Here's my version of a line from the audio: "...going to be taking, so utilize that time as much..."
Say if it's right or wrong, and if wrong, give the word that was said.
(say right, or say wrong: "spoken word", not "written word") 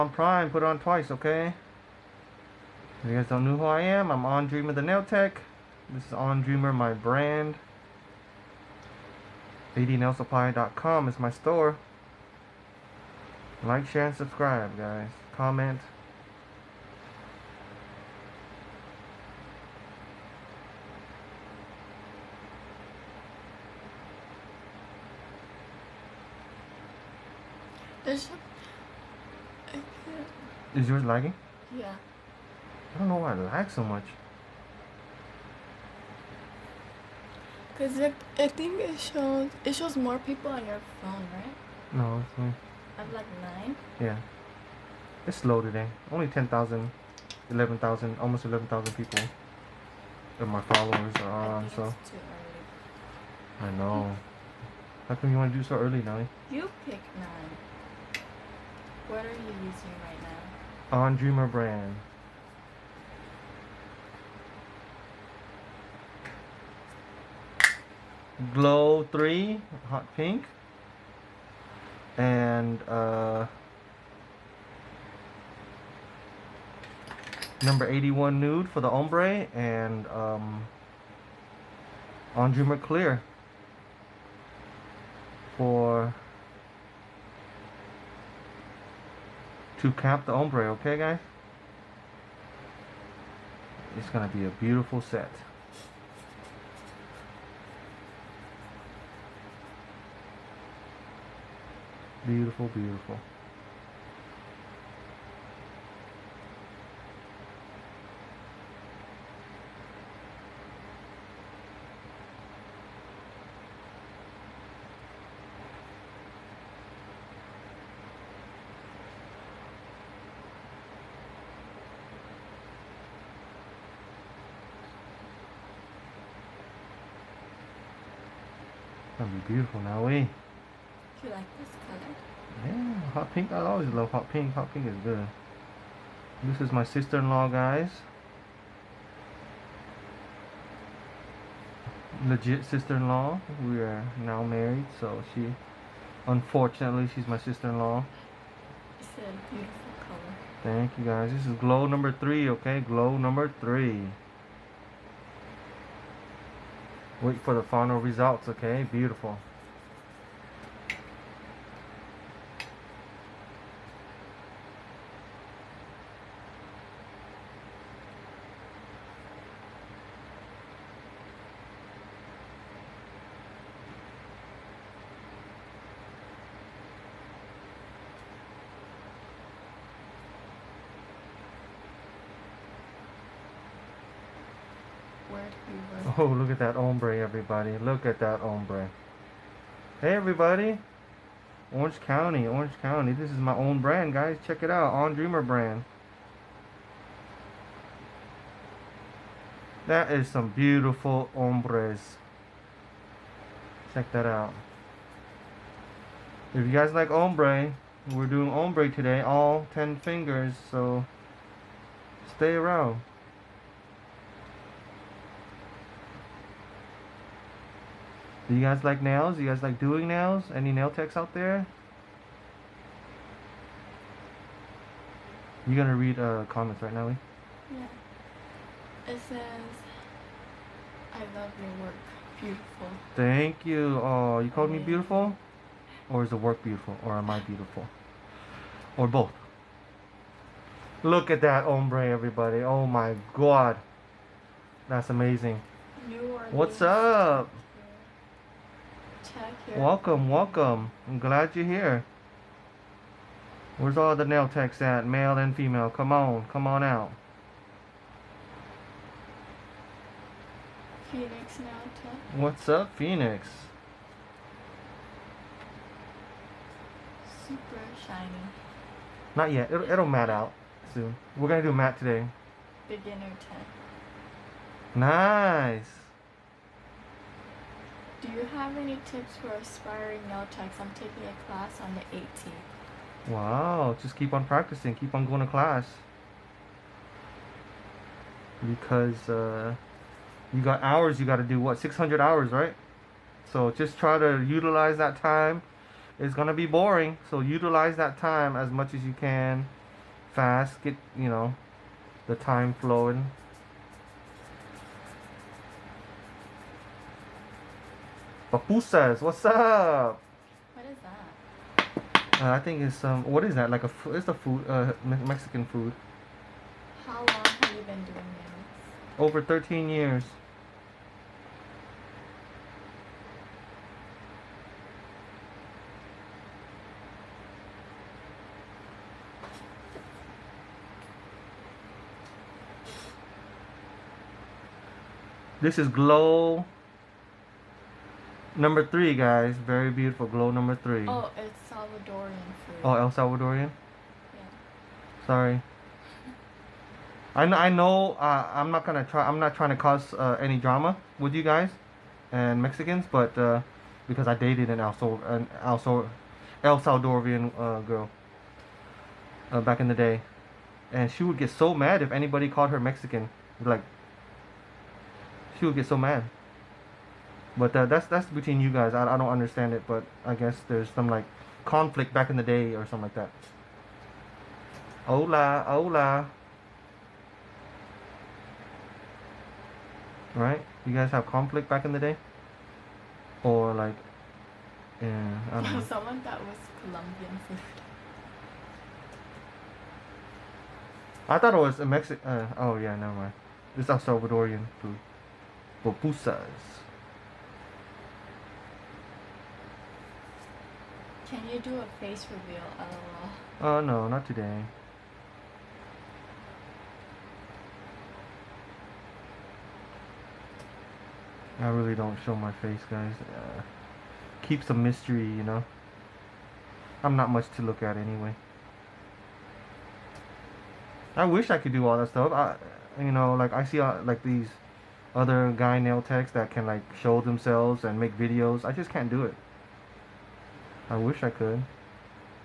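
wrong: "boring", not "taking".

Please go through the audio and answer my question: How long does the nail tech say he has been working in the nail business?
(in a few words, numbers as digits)
Over 13 years.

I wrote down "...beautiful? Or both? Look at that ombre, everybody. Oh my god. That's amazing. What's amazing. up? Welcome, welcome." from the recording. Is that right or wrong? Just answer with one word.
right.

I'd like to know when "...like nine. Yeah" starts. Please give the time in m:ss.
0:43.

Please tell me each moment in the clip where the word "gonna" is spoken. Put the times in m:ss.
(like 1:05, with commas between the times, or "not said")
1:34, 2:09, 3:45, 5:48.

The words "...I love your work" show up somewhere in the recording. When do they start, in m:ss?
3:51.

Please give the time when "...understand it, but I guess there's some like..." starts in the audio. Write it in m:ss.
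6:09.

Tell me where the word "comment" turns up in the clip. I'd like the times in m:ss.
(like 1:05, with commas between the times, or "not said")
0:15, 3:46.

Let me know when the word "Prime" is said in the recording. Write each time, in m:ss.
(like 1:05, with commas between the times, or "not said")
0:00.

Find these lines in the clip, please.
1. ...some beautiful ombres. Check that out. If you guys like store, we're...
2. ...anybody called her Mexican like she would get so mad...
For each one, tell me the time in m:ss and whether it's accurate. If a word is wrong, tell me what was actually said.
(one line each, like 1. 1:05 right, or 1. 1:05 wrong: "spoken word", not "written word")
1. 3:20 wrong: "ombre", not "store"
2. 6:02 right.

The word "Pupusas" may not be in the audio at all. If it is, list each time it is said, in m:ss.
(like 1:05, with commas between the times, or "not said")
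5:08, 6:35.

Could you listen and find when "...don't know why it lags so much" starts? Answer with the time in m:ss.
0:32.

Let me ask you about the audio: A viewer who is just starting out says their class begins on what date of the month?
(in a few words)
18th.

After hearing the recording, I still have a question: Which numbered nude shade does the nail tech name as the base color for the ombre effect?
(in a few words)
81.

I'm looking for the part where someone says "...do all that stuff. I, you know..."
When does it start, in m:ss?
7:01.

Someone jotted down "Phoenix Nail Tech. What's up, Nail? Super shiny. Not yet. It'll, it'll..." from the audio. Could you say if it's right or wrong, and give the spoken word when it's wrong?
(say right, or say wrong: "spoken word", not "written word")
wrong: "Phoenix", not "Nail".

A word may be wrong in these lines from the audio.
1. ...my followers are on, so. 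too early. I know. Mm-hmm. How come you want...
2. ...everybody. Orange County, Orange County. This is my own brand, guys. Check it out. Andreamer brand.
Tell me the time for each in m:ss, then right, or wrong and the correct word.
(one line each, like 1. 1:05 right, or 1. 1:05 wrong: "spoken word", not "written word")
1. 0:50 right
2. 3:10 right.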